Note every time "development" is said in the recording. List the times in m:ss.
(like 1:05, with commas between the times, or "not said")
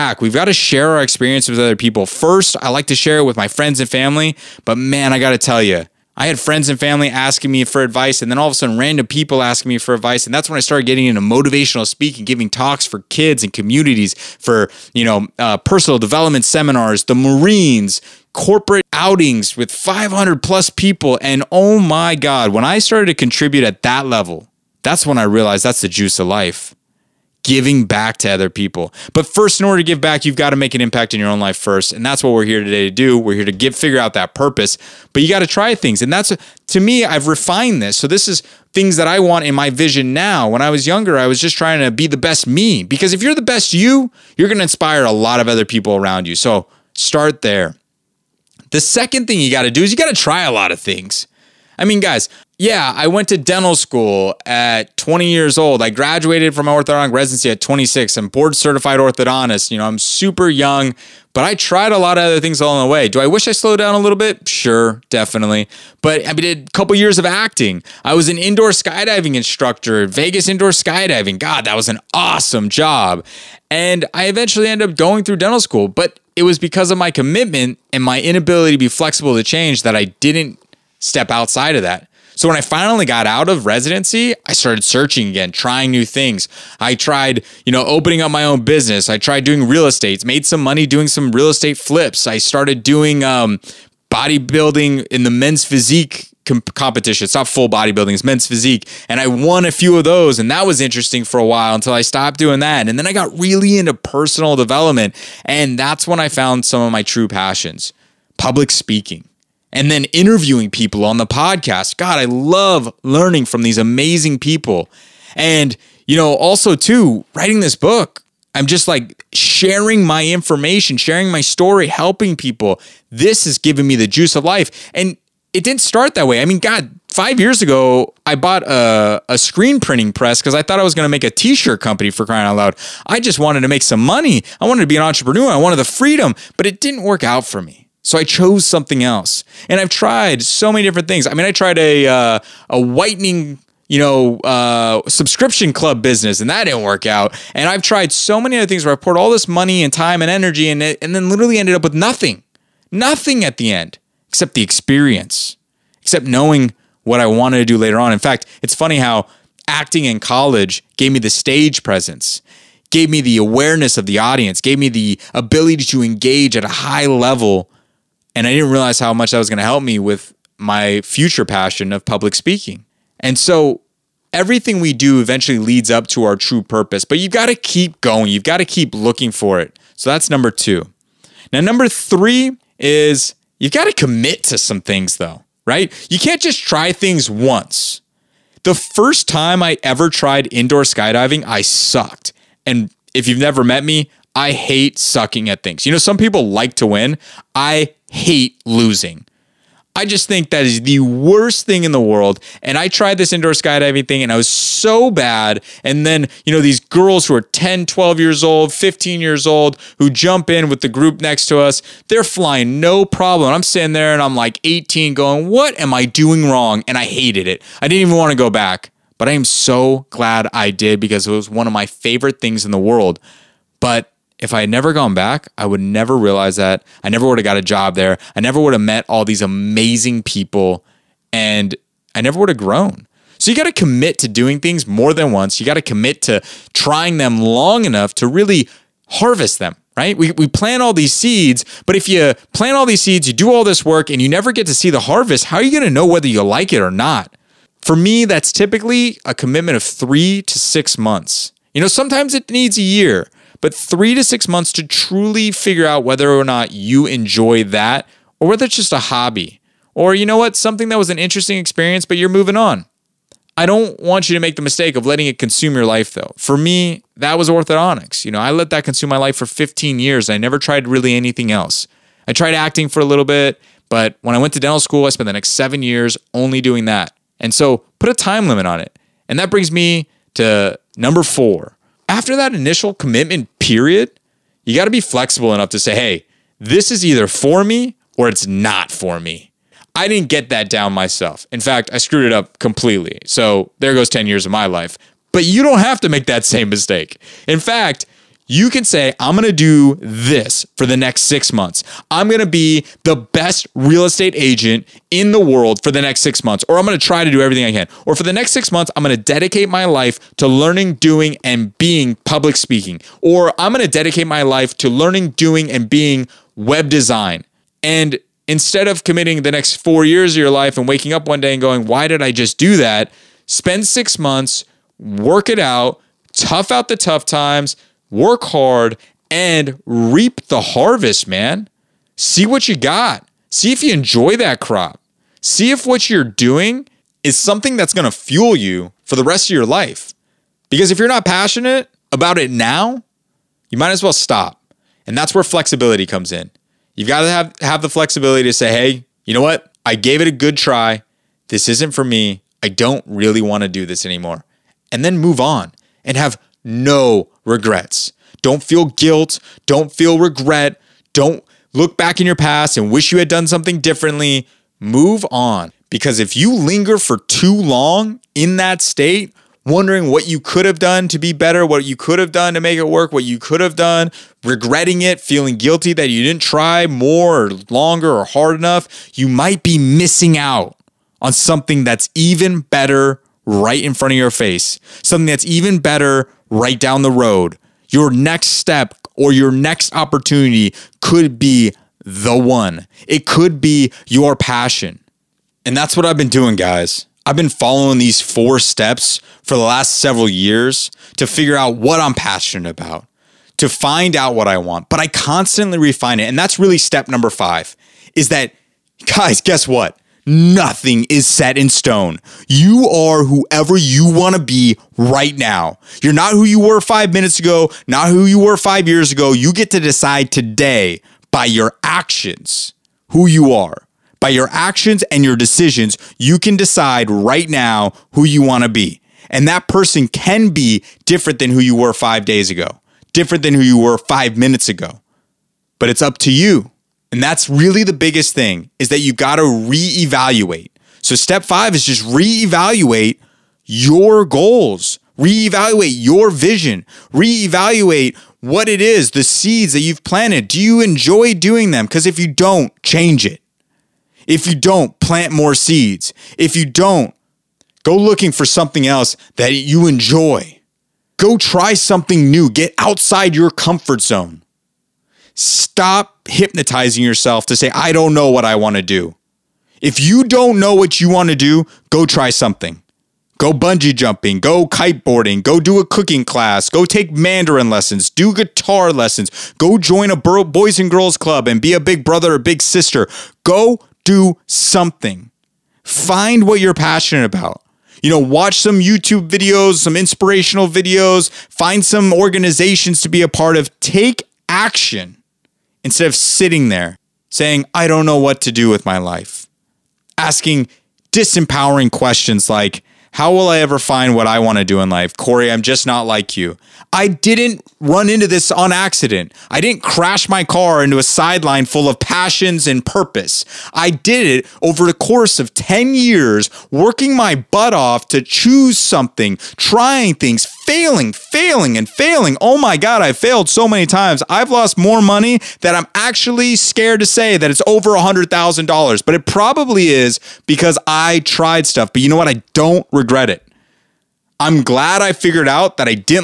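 0:15, 1:44.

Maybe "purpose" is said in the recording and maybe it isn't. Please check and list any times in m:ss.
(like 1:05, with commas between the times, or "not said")
0:34, 2:56, 8:32.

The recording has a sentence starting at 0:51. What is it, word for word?
I mean, guys, yeah, I went to dental school at 20 years old.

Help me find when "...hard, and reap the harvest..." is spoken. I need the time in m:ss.
5:28.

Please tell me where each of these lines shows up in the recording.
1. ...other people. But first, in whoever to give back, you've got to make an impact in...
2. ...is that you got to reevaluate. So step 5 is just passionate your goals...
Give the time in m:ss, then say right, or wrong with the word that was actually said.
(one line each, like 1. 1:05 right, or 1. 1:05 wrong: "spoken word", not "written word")
1. 0:28 wrong: "order", not "whoever"
2. 7:18 wrong: "reevaluate", not "passionate".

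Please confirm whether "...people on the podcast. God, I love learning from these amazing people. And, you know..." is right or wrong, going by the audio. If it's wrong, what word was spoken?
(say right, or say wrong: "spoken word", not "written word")
right.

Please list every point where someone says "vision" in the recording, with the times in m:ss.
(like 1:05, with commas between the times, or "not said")
0:39, 7:26.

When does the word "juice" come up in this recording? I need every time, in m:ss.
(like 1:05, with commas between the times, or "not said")
0:25, 2:04.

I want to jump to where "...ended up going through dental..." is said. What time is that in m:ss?
1:14.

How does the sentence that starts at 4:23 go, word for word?
I don't want you to make the mistake of letting it consume your life though.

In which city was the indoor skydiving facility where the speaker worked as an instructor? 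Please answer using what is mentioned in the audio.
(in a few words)
Vegas.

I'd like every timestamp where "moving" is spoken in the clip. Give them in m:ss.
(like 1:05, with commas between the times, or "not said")
4:22.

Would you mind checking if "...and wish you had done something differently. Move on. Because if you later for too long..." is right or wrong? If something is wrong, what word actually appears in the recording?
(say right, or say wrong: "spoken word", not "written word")
wrong: "linger", not "later".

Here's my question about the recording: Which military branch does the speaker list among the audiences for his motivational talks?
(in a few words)
the Marines.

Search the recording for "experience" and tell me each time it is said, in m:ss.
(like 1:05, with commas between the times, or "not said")
0:01, 2:34, 4:21.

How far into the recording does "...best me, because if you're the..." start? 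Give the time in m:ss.
0:42.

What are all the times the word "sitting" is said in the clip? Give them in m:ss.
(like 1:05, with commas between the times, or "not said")
3:33, 8:16.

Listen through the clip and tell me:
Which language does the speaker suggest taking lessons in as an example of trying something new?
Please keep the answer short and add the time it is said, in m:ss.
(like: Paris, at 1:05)
Mandarin, at 7:57.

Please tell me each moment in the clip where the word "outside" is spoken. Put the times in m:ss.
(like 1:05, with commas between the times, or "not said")
1:21, 7:42.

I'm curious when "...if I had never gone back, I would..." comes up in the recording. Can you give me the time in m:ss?
3:44.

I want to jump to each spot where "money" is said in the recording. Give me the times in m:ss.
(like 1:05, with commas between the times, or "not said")
1:30, 2:14, 2:29, 8:45.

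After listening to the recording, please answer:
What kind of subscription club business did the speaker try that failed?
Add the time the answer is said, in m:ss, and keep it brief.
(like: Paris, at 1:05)
whitening, at 2:22.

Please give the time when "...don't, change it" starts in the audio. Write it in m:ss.
7:32.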